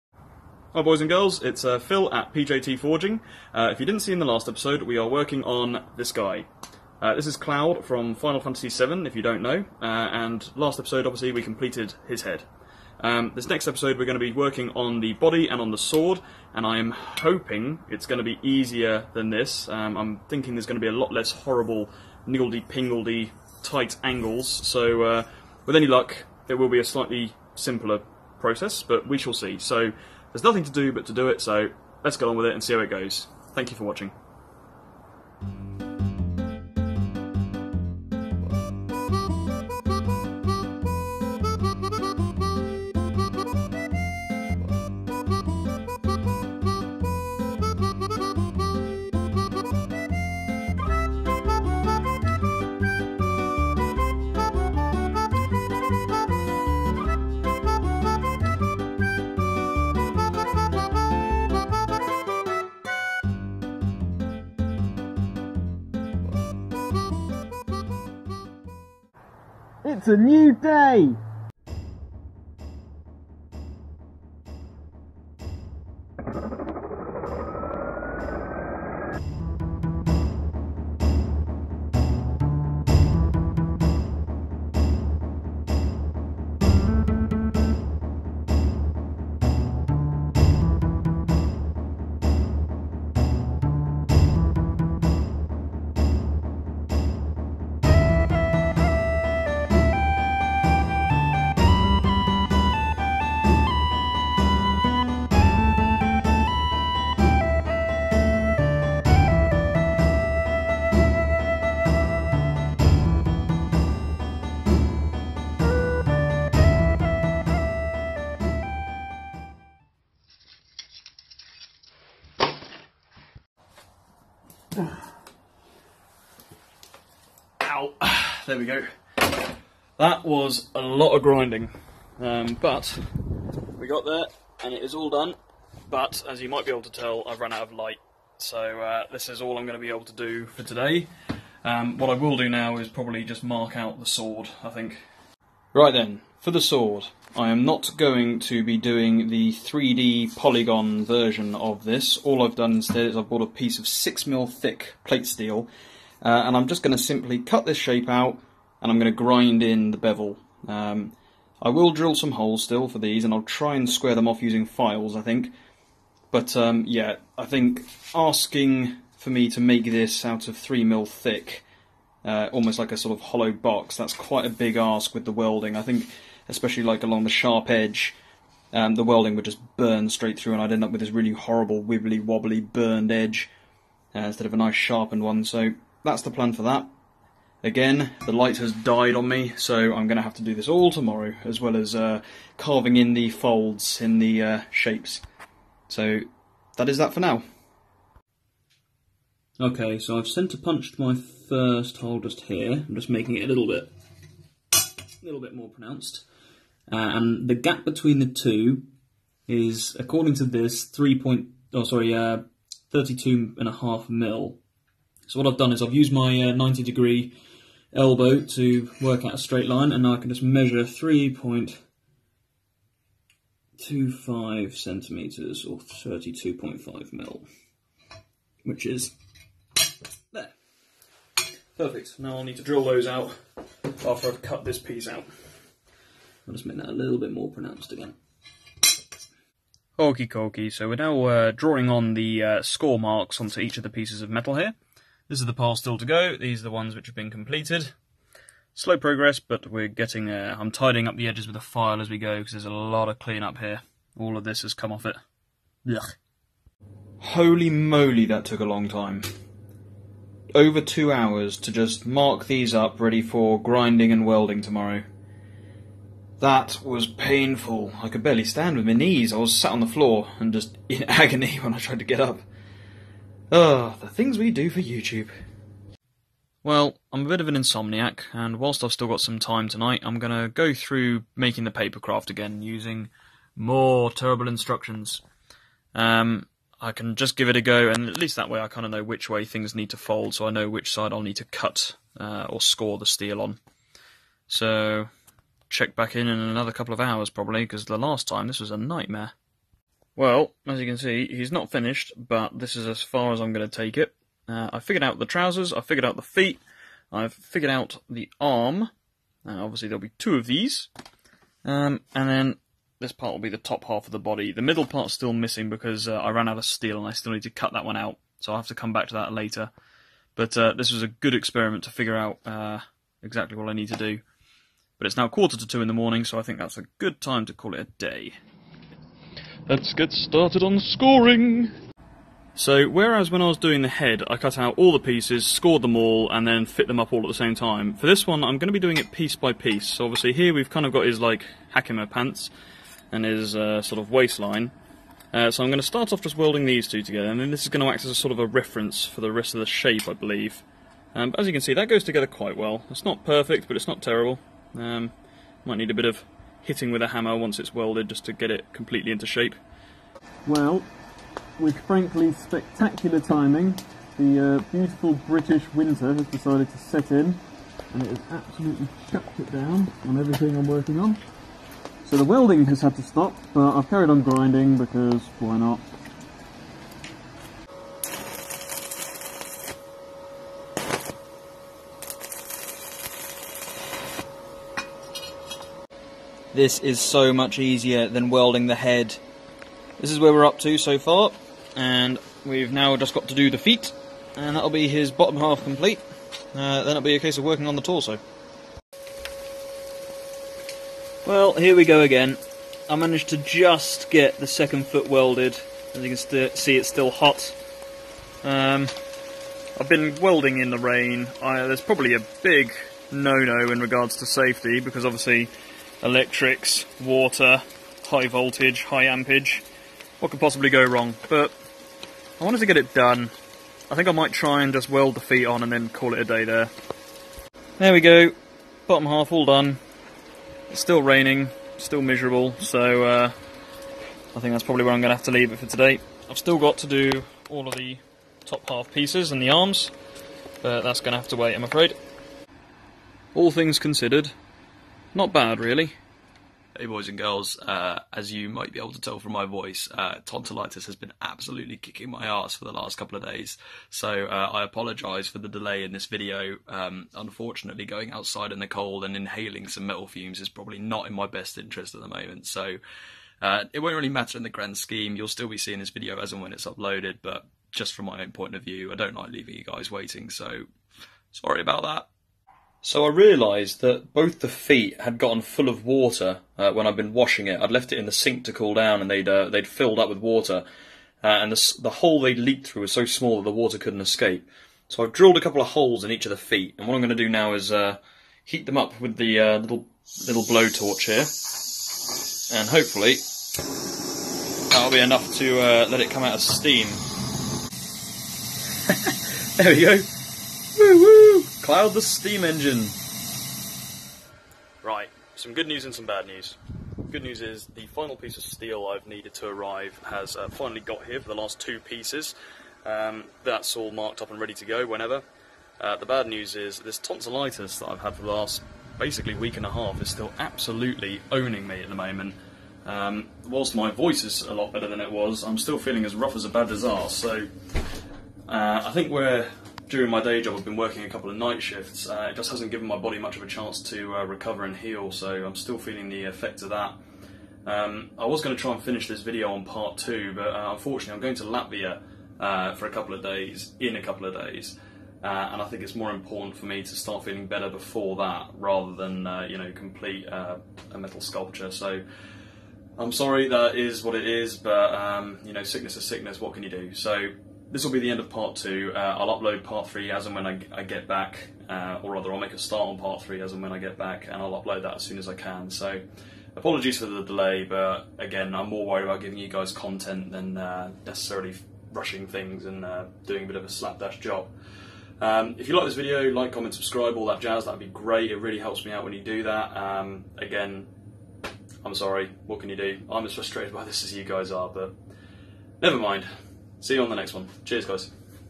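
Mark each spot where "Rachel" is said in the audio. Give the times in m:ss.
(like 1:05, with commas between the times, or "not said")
not said.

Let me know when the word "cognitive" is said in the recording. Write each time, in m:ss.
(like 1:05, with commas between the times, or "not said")
not said.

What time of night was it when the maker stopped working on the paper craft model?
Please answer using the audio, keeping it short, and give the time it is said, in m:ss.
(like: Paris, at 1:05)
Quarter to two, at 5:25.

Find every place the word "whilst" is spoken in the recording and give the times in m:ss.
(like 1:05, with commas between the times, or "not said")
4:38, 8:43.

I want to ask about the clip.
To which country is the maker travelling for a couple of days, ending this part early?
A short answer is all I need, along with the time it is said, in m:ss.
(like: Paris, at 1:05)
Latvia, at 9:01.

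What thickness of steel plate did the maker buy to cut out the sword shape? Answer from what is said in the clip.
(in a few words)
6mm.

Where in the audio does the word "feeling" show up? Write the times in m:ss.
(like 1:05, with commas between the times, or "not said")
8:45, 8:55, 9:07.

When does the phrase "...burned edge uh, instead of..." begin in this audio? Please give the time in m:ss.
3:02.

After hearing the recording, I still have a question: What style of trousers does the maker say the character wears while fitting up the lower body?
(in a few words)
Hakama pants.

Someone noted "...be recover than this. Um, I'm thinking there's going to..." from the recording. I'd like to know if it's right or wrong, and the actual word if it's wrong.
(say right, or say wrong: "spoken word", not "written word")
wrong: "easier", not "recover".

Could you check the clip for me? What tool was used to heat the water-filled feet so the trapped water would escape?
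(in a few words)
Blowtorch.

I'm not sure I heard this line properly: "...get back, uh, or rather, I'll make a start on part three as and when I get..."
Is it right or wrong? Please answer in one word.
right.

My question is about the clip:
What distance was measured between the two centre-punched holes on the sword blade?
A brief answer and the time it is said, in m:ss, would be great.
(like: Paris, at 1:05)
32.5 mm, at 3:32.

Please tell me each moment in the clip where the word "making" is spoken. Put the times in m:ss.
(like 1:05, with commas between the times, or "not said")
3:23, 4:41.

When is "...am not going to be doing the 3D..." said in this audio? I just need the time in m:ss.
2:27.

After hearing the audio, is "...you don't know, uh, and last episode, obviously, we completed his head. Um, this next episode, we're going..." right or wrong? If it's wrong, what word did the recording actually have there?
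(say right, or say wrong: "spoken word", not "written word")
right.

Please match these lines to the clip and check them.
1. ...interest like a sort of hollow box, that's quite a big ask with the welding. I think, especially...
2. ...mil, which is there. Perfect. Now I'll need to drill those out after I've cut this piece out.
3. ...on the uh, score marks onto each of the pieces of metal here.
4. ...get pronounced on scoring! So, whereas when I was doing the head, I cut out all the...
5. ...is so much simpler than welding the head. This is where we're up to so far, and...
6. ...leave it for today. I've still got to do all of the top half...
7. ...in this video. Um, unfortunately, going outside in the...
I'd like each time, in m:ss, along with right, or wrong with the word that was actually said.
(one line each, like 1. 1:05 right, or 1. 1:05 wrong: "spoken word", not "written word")
1. 2:52 wrong: "almost", not "interest"
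2. 3:47 right
3. 4:01 right
4. 5:29 wrong: "started", not "pronounced"
5. 6:26 wrong: "easier", not "simpler"
6. 7:15 right
7. 7:35 right.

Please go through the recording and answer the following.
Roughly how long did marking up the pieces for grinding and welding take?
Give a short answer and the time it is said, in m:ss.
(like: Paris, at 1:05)
Over two hours, at 4:20.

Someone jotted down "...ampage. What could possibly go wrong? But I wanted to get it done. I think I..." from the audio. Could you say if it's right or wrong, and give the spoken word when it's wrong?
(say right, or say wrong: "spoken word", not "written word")
right.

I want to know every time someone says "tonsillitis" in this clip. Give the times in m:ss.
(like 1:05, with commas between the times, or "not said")
7:30, 8:36.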